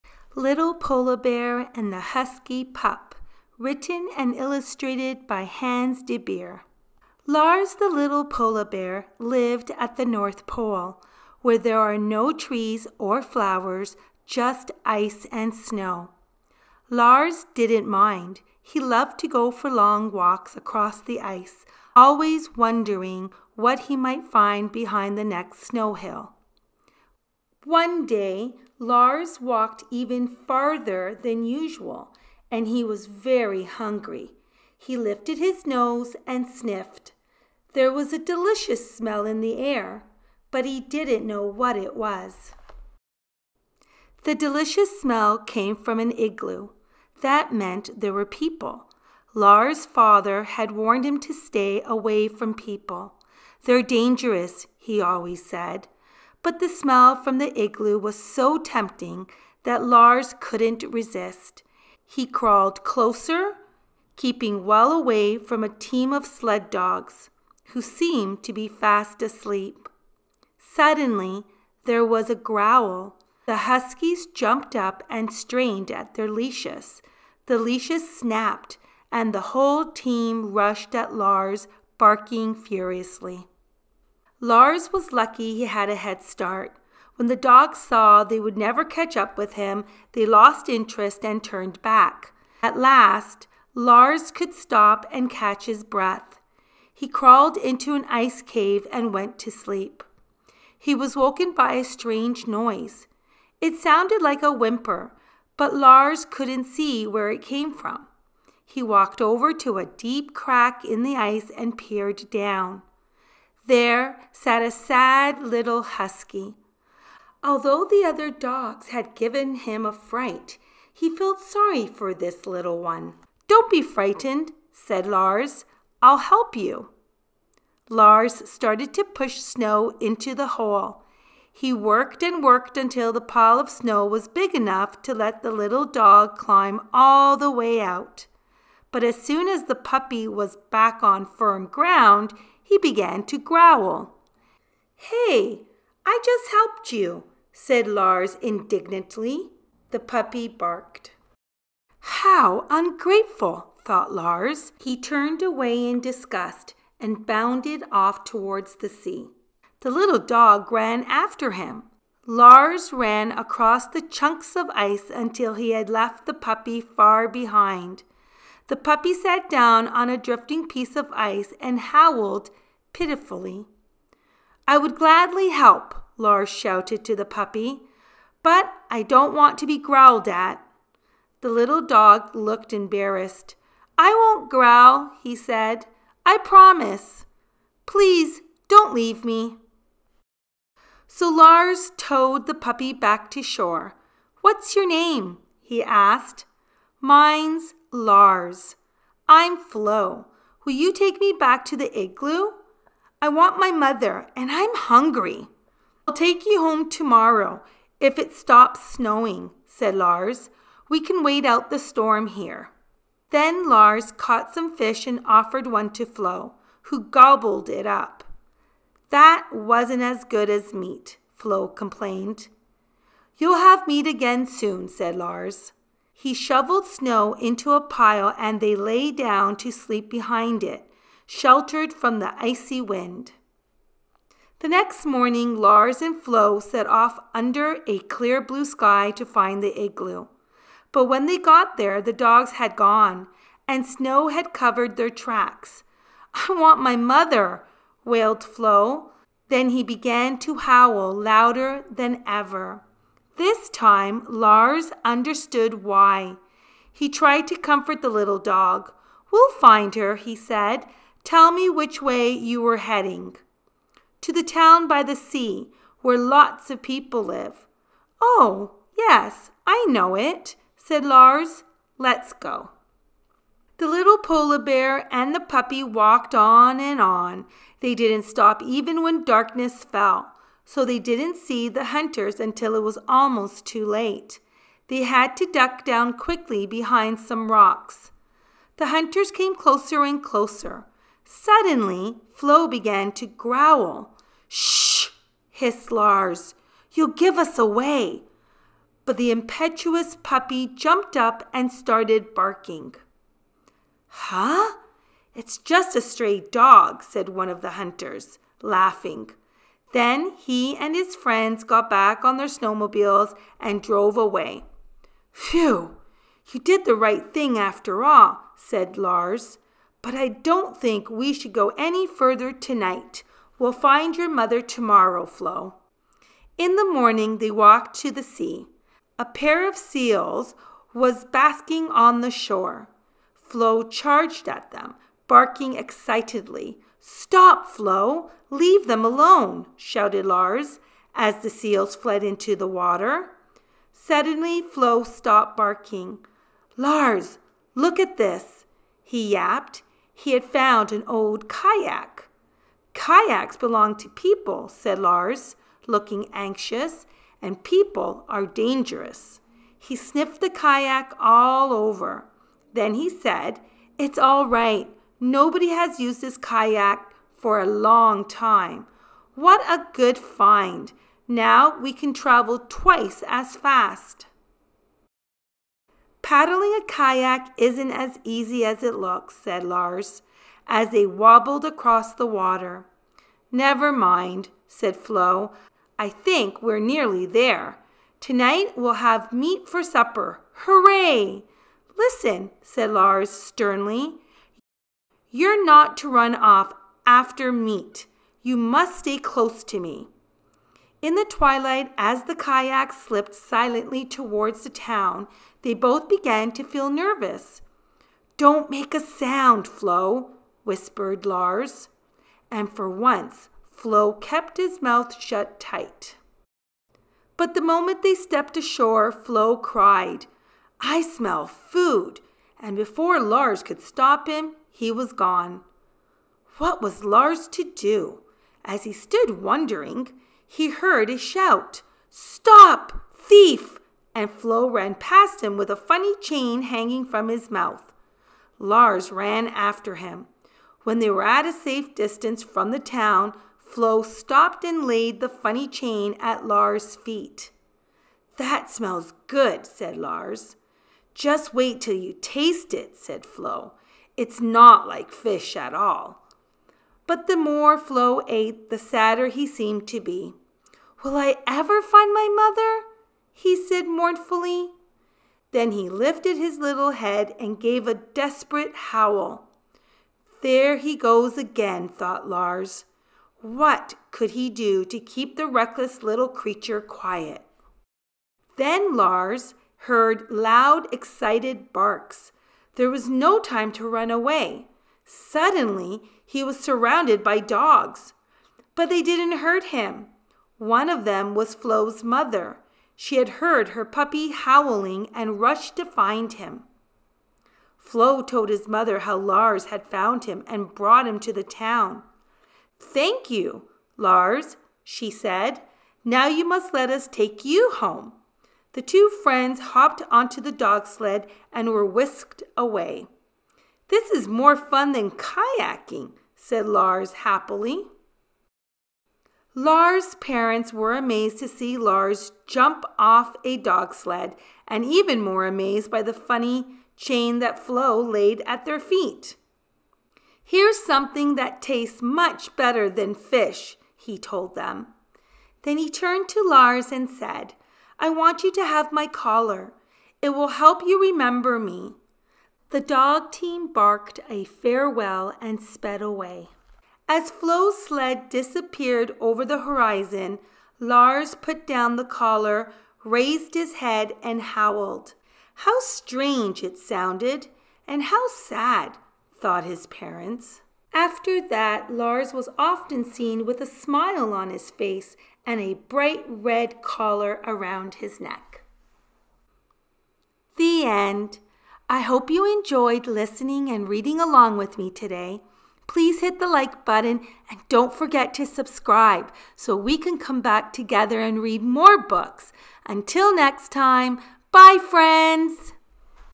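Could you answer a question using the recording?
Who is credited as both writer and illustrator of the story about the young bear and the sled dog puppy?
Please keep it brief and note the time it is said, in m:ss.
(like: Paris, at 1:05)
Hans de Beer, at 0:05.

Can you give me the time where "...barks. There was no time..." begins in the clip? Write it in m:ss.
8:01.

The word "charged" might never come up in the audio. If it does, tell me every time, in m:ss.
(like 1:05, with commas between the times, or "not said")
5:33.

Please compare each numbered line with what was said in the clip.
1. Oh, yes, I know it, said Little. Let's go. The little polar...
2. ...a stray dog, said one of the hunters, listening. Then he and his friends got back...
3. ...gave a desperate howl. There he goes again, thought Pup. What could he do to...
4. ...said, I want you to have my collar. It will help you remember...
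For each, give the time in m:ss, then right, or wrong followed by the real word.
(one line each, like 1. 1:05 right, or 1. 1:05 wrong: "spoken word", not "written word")
1. 4:28 wrong: "Lars", not "Little"
2. 5:05 wrong: "laughing", not "listening"
3. 7:47 wrong: "Lars", not "Pup"
4. 8:57 right.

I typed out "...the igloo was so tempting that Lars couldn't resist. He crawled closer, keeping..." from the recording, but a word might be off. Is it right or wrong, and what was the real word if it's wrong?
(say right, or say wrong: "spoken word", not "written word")
right.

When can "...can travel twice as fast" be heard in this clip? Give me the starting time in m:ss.
6:11.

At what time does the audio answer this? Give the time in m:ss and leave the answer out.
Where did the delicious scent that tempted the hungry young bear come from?
0:45.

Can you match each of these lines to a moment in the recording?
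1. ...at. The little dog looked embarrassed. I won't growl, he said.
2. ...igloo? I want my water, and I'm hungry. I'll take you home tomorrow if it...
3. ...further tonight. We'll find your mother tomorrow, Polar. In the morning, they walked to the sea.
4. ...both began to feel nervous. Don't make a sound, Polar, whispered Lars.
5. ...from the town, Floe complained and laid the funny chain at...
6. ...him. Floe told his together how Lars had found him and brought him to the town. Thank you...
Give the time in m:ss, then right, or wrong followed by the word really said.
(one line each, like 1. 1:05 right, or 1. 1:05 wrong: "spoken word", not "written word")
1. 3:00 right
2. 3:21 wrong: "mother", not "water"
3. 5:22 wrong: "Floe", not "Polar"
4. 6:45 wrong: "Floe", not "Polar"
5. 7:22 wrong: "stopped", not "complained"
6. 8:16 wrong: "mother", not "together".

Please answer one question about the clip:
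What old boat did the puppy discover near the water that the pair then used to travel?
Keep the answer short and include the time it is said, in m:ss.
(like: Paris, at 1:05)
A kayak, at 5:50.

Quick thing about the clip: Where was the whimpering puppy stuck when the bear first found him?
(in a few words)
A deep crack in the ice.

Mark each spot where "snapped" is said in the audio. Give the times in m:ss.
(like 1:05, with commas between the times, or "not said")
1:18.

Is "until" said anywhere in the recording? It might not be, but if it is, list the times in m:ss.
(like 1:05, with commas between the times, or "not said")
2:12, 2:45, 4:42, 9:42.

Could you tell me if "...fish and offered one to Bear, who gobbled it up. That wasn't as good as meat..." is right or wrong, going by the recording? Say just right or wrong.
wrong.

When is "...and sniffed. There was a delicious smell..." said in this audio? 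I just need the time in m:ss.
0:36.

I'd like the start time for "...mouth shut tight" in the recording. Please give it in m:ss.
6:54.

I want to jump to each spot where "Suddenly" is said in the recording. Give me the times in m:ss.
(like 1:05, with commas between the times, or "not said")
1:10, 4:51, 5:43, 8:05.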